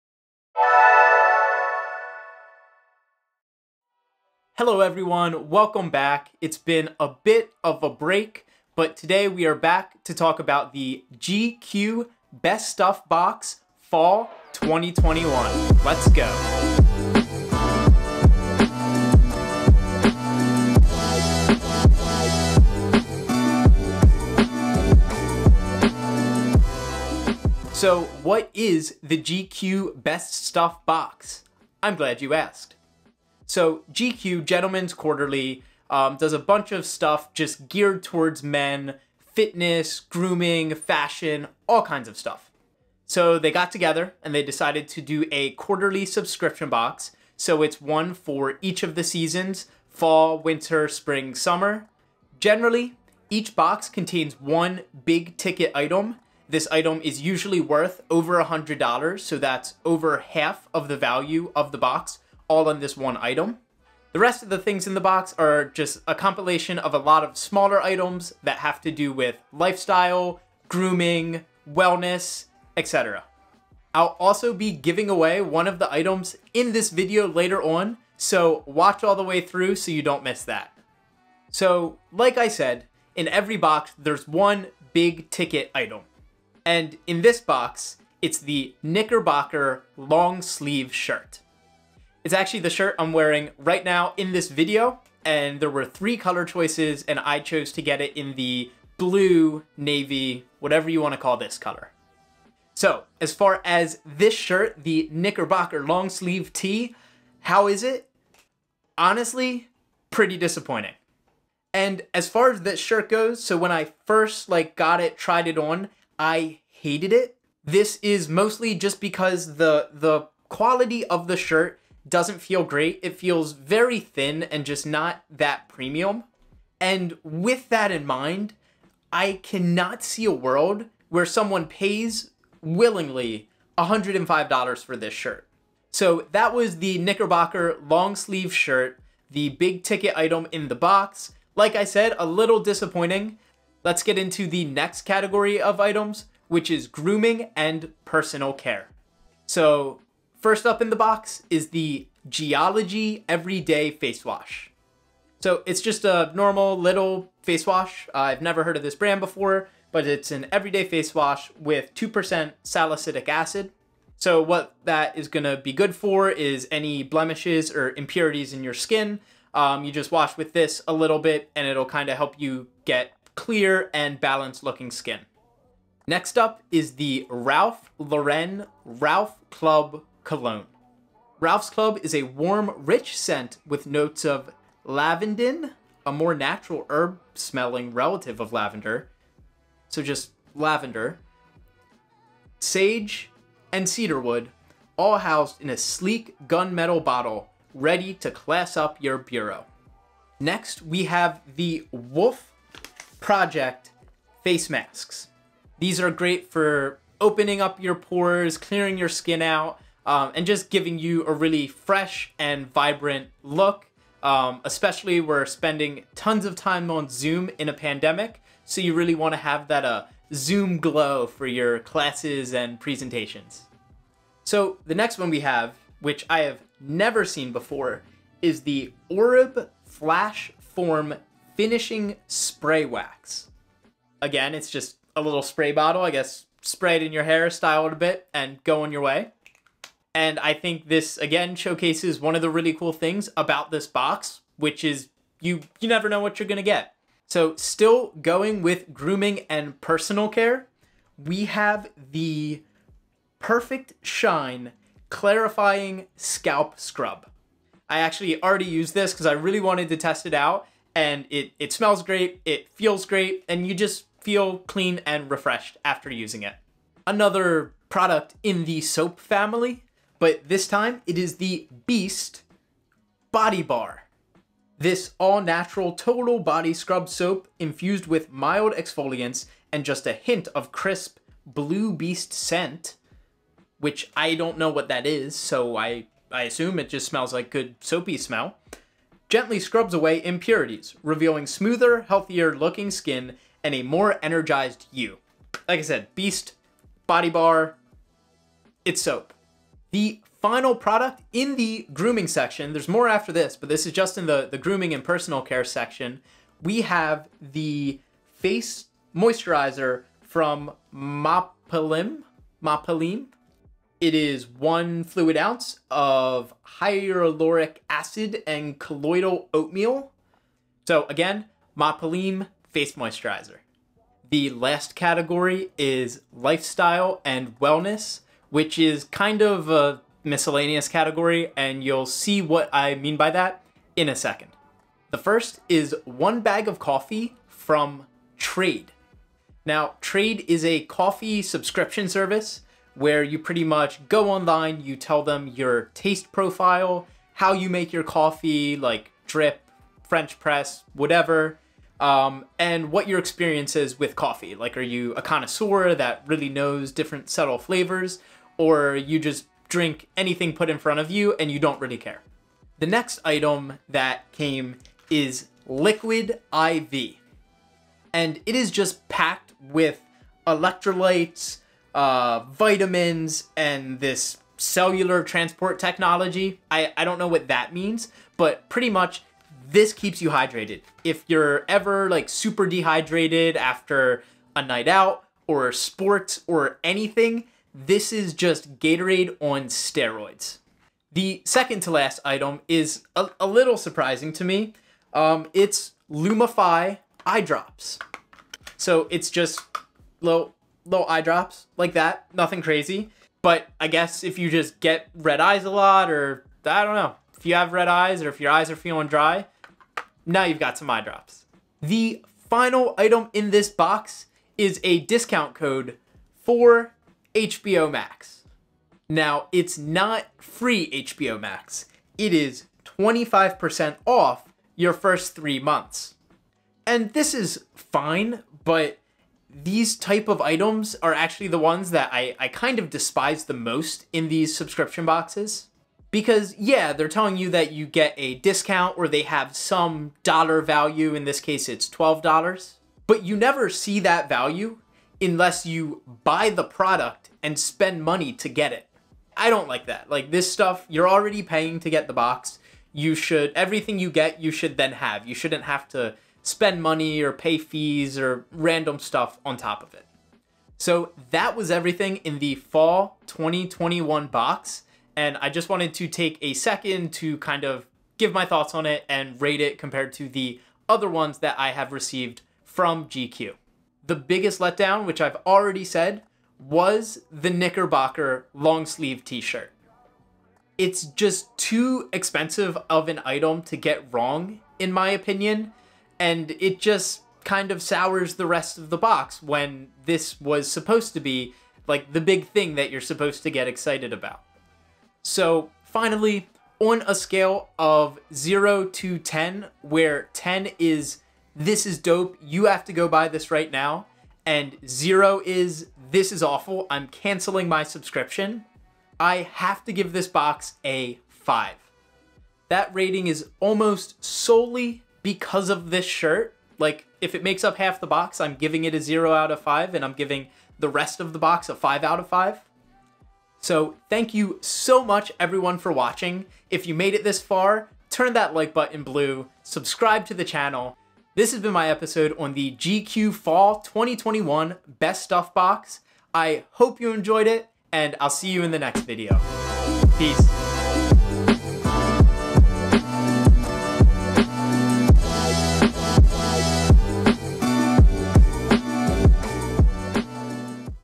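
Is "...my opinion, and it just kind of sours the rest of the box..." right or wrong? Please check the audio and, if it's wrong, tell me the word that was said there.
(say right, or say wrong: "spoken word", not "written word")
right.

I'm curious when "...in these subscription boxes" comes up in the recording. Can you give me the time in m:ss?
7:14.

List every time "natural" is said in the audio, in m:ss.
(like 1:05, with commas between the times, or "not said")
3:06, 4:35.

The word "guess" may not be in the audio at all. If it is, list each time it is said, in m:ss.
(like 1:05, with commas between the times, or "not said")
3:56, 6:43.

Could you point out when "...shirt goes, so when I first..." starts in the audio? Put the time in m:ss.
1:52.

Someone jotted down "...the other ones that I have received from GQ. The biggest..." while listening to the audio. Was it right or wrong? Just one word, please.
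right.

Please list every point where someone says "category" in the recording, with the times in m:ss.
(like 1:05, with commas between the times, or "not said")
2:25, 5:24, 5:30.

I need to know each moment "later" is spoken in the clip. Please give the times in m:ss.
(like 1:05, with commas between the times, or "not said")
1:17.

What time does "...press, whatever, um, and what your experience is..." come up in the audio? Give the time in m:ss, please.
5:50.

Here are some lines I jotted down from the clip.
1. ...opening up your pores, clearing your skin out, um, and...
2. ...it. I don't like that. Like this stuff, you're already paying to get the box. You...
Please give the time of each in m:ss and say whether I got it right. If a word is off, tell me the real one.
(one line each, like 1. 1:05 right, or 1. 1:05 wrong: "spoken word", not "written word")
1. 3:27 right
2. 7:28 right.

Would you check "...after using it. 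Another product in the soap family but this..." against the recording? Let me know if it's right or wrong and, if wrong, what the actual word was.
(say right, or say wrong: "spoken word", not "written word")
right.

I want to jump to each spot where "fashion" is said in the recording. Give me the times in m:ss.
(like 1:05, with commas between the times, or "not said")
0:40.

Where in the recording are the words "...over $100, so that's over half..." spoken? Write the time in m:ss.
0:58.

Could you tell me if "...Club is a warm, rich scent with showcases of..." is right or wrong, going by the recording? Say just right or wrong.
wrong.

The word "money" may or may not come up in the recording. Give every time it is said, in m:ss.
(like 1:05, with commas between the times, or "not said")
7:28, 7:36.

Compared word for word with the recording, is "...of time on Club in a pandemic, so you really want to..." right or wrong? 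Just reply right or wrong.
wrong.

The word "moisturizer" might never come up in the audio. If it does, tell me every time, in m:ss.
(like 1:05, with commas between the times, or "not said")
5:09, 5:22.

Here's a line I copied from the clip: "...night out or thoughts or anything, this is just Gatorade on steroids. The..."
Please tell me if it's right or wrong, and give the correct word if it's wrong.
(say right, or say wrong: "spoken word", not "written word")
wrong: "sports", not "thoughts".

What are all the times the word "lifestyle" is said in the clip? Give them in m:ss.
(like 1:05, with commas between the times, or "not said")
1:09, 5:26.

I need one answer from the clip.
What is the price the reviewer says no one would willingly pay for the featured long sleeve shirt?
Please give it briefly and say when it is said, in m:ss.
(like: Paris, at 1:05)
$105, at 2:13.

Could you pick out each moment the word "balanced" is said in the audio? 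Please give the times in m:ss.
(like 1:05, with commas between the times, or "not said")
2:54.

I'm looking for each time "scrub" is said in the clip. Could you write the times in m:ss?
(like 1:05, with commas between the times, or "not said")
4:16, 4:36, 4:49.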